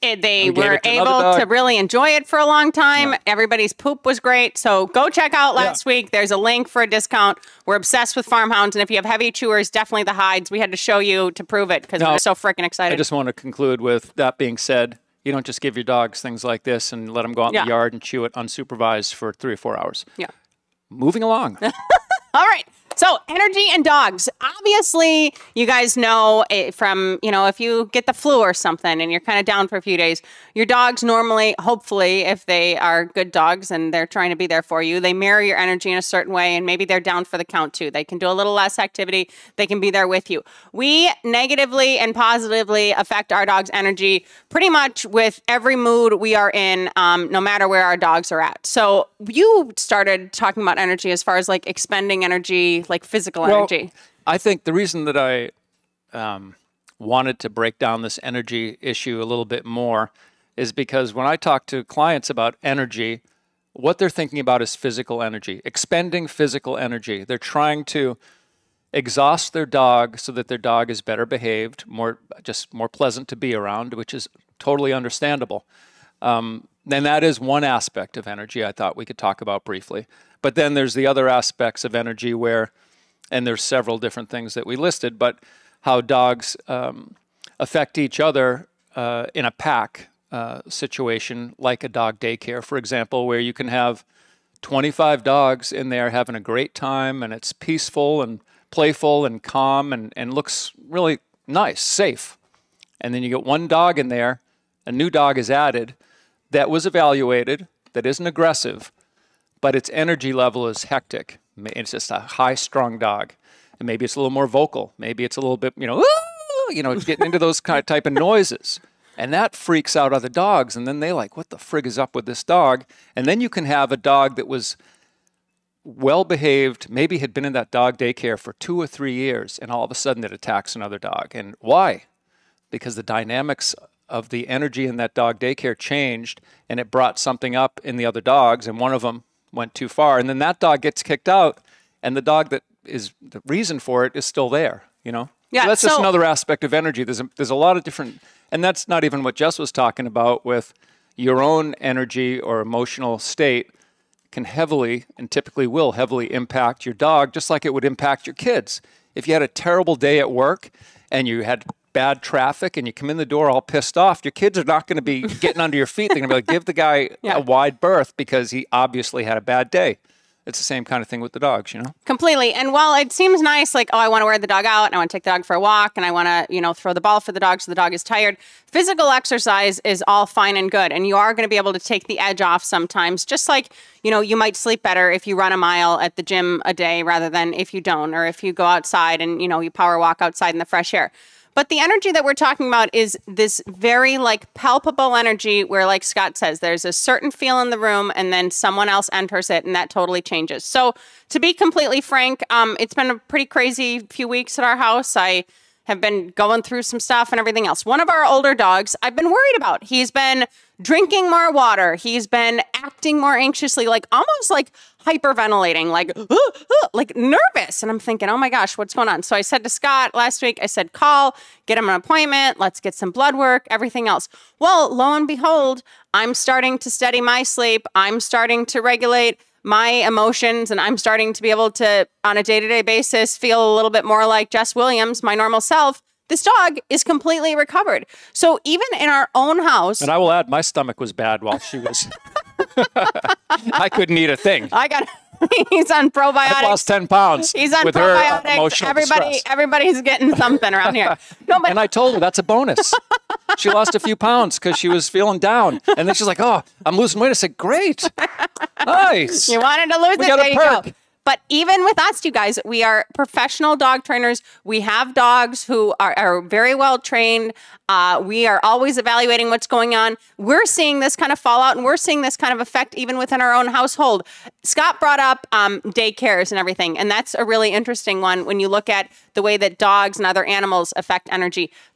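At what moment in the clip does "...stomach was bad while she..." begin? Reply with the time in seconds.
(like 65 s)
240 s.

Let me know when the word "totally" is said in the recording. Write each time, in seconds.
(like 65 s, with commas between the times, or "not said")
74 s, 199 s.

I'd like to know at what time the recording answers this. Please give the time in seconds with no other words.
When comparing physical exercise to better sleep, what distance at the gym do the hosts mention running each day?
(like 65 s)
185 s.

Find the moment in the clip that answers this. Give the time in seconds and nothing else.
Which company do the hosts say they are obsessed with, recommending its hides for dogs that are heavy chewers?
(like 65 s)
8 s.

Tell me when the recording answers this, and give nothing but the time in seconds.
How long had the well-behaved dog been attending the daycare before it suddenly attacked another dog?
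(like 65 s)
128 s.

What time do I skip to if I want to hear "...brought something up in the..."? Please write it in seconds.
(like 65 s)
136 s.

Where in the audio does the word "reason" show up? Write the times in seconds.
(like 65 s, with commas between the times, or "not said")
54 s, 143 s.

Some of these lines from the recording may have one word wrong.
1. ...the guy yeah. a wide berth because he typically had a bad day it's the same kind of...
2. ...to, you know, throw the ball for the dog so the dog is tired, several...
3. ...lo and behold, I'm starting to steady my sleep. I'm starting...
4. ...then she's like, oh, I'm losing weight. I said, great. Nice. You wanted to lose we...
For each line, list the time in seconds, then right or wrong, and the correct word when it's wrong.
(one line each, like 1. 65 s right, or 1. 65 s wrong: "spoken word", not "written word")
1. 166 s wrong: "obviously", not "typically"
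2. 176 s wrong: "physical", not "several"
3. 224 s right
4. 256 s right.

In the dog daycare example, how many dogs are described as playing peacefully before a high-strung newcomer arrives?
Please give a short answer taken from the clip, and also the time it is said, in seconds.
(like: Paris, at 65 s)
25, at 94 s.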